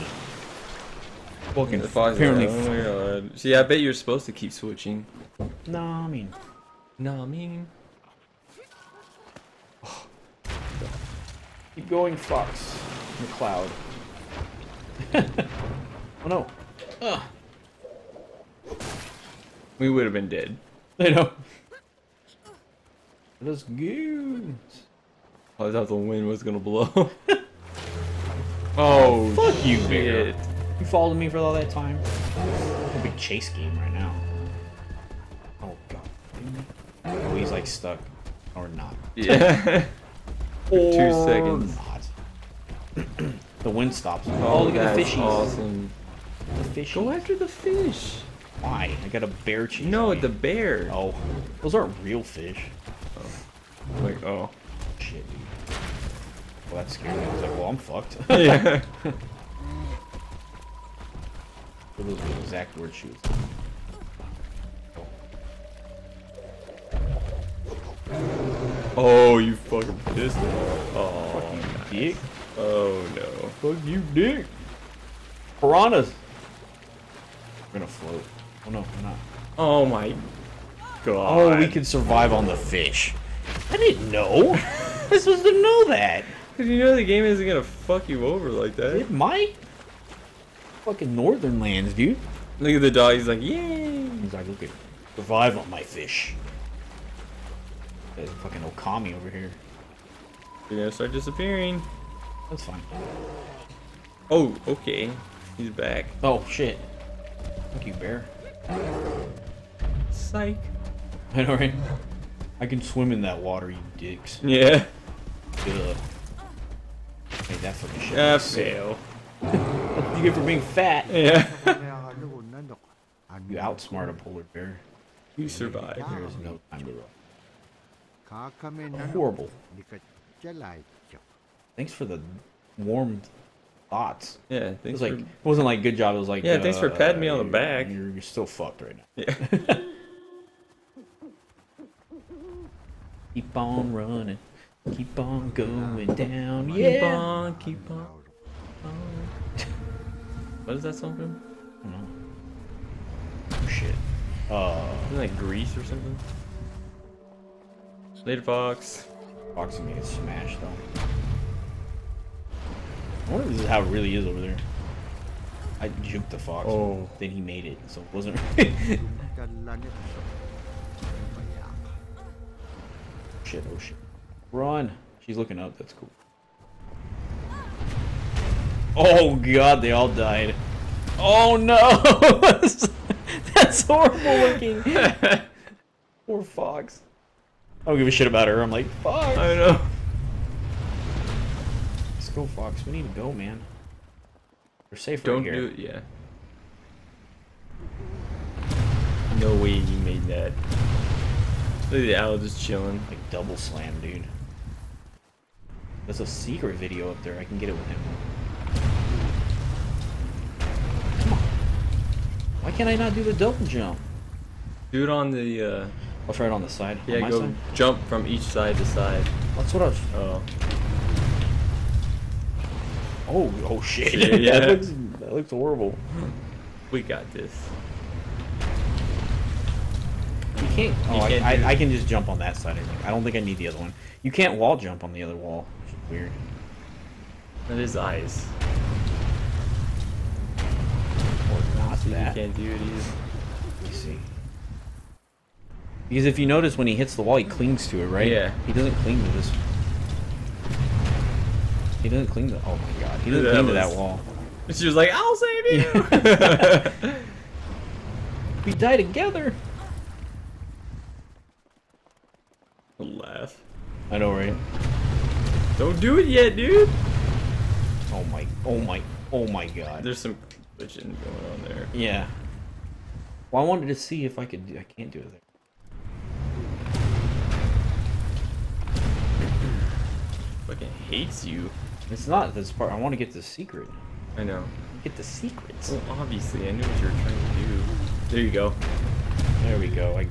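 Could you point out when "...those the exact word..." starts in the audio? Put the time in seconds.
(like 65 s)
62 s.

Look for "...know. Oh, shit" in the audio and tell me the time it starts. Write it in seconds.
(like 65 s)
152 s.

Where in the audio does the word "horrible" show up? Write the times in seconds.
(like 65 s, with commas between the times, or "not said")
129 s, 183 s, 225 s.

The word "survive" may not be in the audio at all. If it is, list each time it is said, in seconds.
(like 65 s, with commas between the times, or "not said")
81 s, 125 s.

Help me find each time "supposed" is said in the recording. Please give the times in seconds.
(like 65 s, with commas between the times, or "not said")
3 s, 85 s.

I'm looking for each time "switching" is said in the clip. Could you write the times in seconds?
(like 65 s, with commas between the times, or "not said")
4 s.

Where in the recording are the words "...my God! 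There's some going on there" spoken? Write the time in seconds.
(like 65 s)
269 s.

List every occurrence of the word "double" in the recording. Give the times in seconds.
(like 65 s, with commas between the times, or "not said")
203 s, 213 s.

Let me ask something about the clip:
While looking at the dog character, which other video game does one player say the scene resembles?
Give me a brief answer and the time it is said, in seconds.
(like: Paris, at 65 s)
Okami, at 98 s.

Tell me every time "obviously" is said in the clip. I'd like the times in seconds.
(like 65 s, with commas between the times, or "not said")
286 s.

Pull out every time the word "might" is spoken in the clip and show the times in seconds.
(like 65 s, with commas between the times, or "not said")
89 s.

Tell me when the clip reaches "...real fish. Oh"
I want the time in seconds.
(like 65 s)
52 s.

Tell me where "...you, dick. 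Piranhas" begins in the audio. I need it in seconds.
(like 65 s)
73 s.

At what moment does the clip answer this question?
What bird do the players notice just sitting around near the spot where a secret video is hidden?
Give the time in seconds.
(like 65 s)
202 s.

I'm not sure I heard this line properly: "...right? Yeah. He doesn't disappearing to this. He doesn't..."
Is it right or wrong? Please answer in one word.
wrong.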